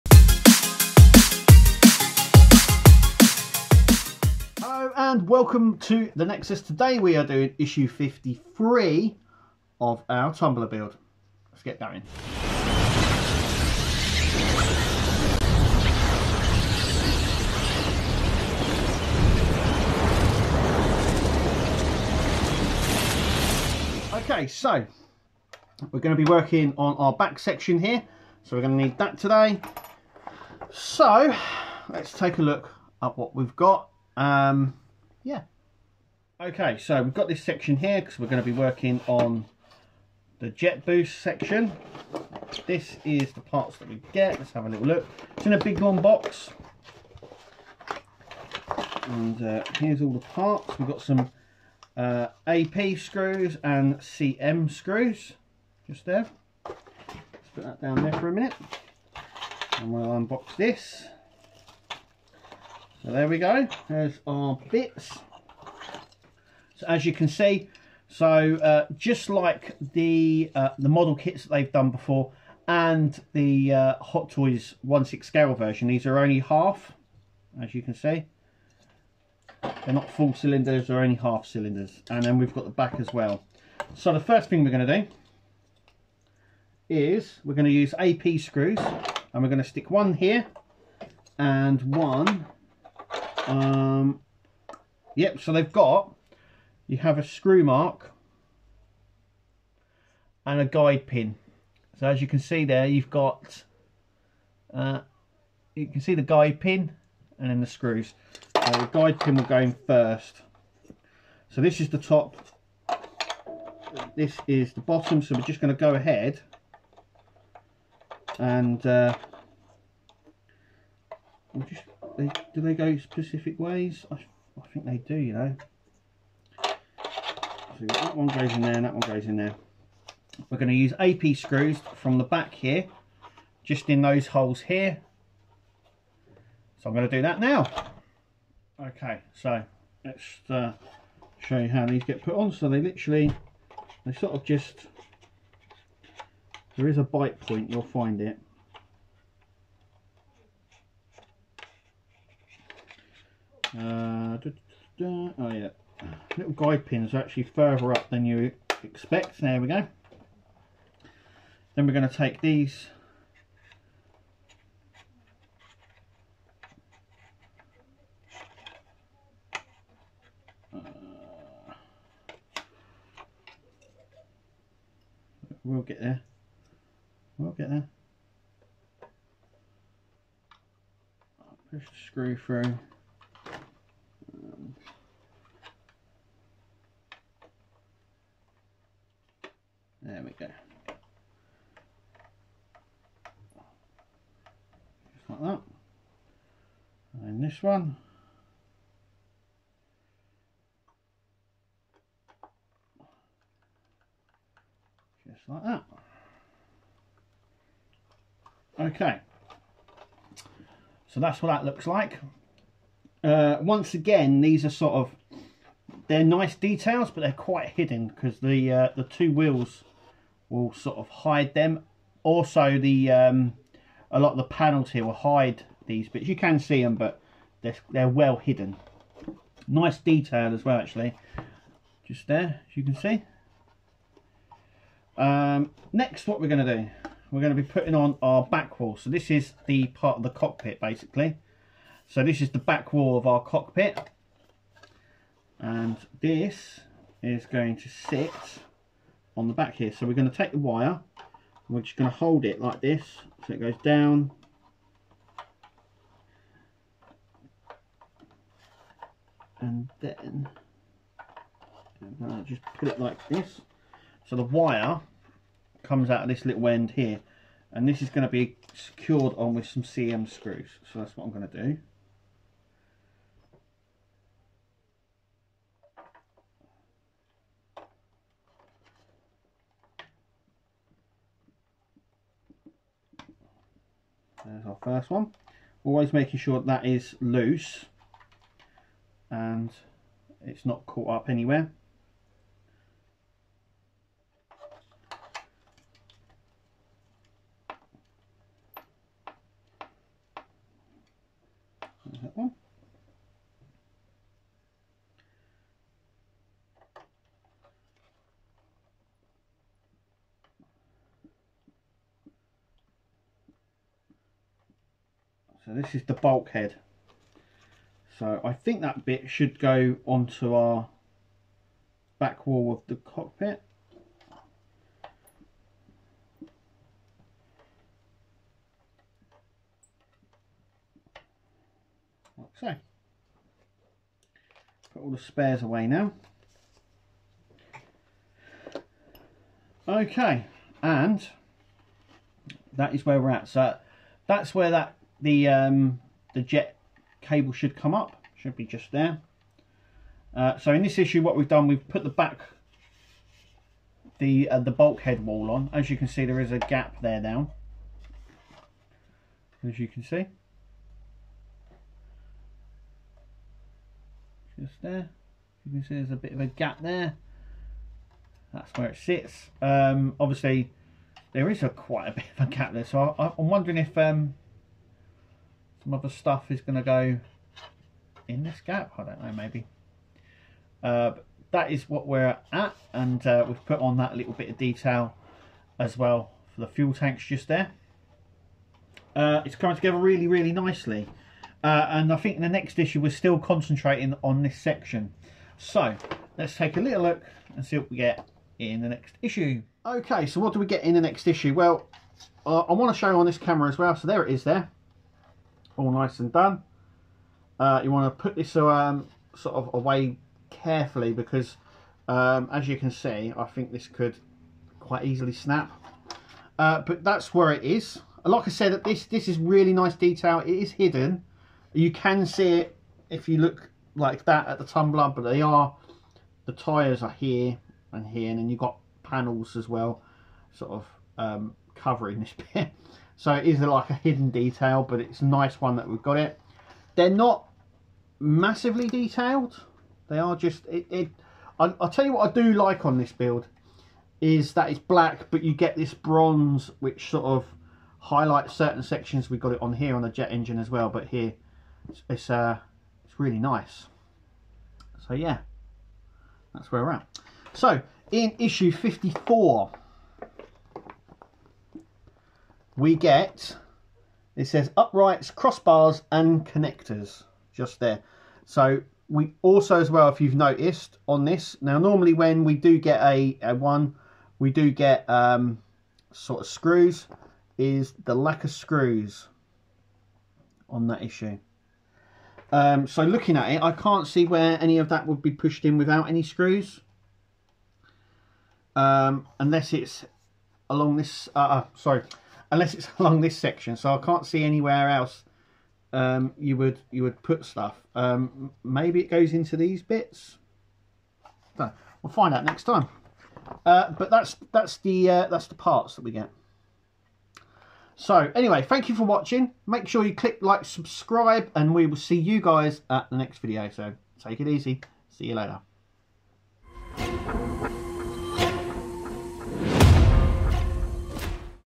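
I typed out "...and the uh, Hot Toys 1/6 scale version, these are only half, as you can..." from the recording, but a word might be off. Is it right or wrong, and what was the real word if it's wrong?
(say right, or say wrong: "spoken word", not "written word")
right.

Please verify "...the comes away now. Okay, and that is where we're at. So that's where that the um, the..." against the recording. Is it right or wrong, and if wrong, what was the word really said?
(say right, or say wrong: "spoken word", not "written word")
wrong: "spares", not "comes".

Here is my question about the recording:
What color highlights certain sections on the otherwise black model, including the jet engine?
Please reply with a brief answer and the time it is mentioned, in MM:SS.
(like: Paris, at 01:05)
bronze, at 07:25.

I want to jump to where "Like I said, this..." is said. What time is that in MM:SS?
06:58.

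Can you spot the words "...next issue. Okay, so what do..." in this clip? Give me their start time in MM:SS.
06:38.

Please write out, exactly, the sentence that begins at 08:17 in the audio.
Um, maybe it goes into these bits.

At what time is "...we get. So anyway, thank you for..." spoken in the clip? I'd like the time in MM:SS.
08:26.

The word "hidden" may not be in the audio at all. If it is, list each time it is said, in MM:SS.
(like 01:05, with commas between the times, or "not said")
03:37, 03:48, 07:00, 07:13.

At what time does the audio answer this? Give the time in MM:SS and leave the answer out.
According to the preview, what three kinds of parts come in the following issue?
07:44.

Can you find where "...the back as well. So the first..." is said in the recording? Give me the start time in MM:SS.
01:22.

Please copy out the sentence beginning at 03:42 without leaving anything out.
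Also, the um, a lot of the panels here will hide these bits.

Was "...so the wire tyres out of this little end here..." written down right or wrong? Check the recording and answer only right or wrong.
wrong.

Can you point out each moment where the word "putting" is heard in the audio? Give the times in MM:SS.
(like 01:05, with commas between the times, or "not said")
03:57.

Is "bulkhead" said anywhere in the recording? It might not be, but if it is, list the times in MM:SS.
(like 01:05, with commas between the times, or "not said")
05:16, 05:54.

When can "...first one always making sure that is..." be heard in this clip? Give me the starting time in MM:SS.
04:44.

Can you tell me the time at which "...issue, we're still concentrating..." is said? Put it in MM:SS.
06:32.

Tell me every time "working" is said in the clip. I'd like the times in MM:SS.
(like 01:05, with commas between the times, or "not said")
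00:26, 00:38.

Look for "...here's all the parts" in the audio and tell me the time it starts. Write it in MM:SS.
00:49.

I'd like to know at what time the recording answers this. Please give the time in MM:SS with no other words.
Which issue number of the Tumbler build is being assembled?
00:07.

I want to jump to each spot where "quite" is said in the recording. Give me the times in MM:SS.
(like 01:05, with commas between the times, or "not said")
03:37, 06:11, 06:54.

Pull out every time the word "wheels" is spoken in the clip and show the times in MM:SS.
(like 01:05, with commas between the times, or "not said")
03:39.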